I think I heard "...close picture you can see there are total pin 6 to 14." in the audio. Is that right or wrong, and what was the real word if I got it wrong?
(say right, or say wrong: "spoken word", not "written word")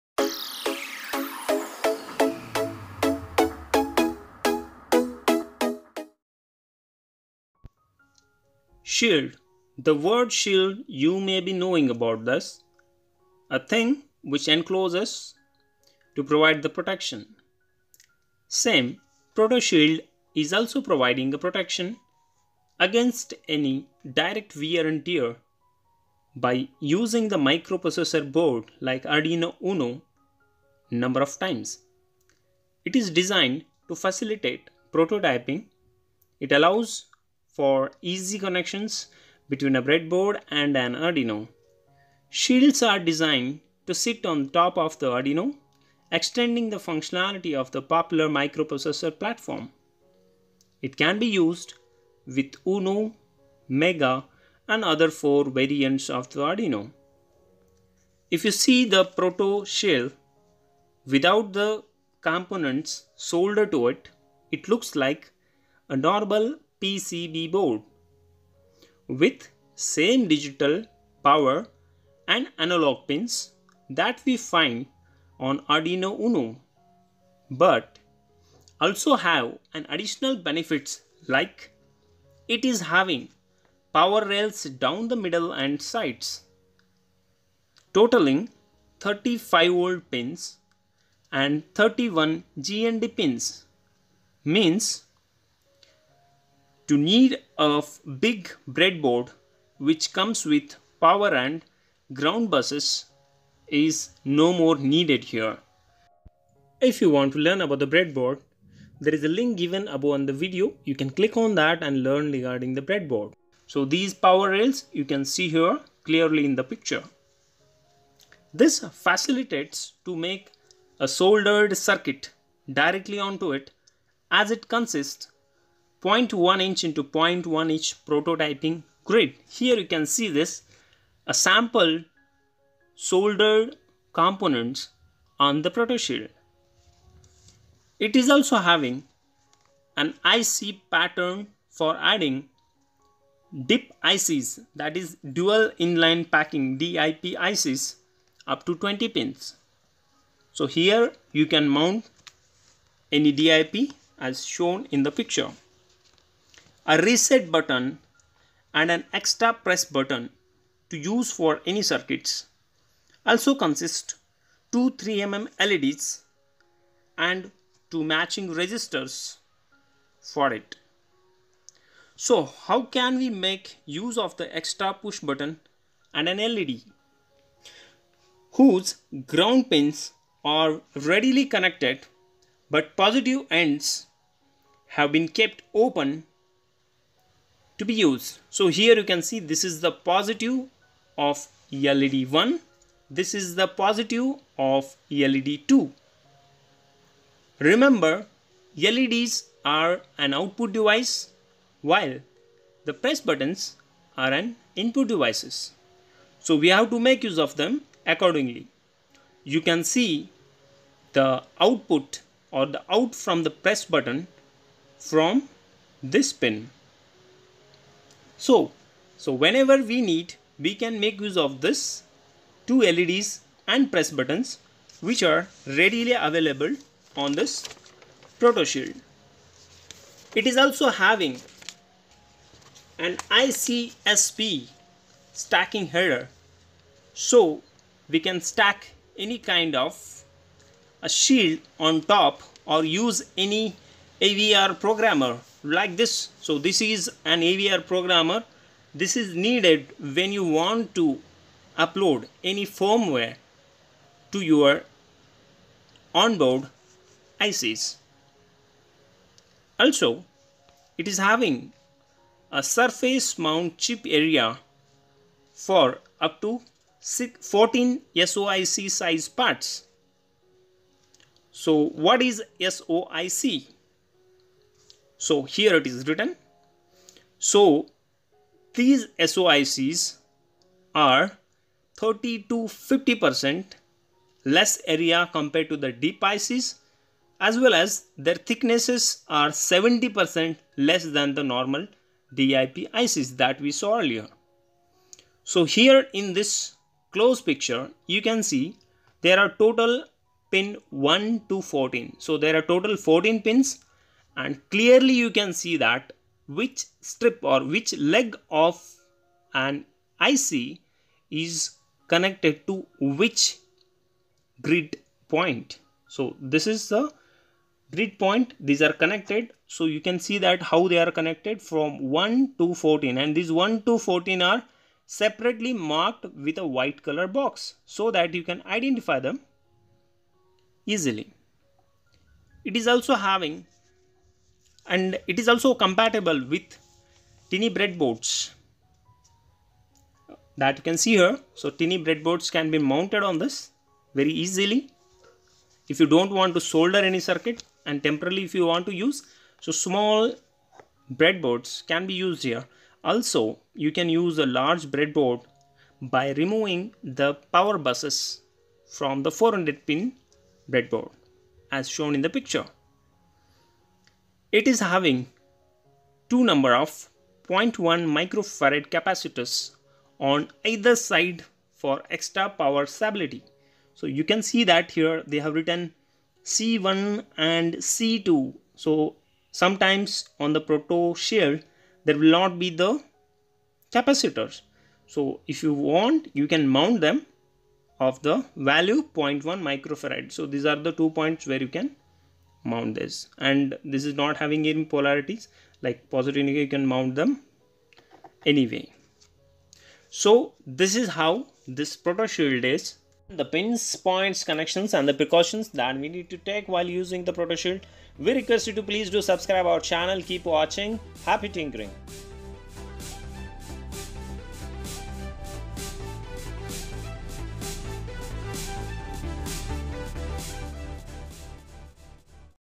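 wrong: "1", not "6".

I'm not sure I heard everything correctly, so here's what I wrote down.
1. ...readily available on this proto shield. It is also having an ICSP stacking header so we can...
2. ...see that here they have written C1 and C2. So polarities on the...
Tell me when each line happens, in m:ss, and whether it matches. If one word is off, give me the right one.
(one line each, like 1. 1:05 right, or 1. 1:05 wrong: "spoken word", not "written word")
1. 3:45 right
2. 6:14 wrong: "sometimes", not "polarities".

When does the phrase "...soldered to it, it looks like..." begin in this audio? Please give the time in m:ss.
1:03.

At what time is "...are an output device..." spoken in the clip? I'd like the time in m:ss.
3:19.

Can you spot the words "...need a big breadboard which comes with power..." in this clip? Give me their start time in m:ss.
1:36.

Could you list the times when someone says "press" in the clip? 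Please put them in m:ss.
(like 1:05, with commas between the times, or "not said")
2:39, 3:22, 3:33, 3:43.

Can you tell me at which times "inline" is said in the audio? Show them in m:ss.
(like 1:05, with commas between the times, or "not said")
2:25.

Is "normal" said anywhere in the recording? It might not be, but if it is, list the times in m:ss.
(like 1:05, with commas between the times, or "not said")
1:05, 4:51.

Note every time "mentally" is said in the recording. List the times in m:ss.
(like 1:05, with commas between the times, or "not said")
not said.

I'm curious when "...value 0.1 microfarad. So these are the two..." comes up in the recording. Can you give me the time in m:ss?
6:28.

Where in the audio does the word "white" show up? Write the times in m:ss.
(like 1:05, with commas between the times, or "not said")
5:26.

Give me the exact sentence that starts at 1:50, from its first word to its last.
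You can click on that and learn regarding the breadboard.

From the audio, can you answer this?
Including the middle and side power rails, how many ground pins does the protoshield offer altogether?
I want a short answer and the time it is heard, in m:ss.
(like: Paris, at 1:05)
31, at 1:31.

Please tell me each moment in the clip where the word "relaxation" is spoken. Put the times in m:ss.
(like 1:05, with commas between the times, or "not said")
not said.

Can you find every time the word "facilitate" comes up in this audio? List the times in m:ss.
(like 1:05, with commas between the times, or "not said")
0:33, 1:58.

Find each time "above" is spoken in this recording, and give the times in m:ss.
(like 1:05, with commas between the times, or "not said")
1:49.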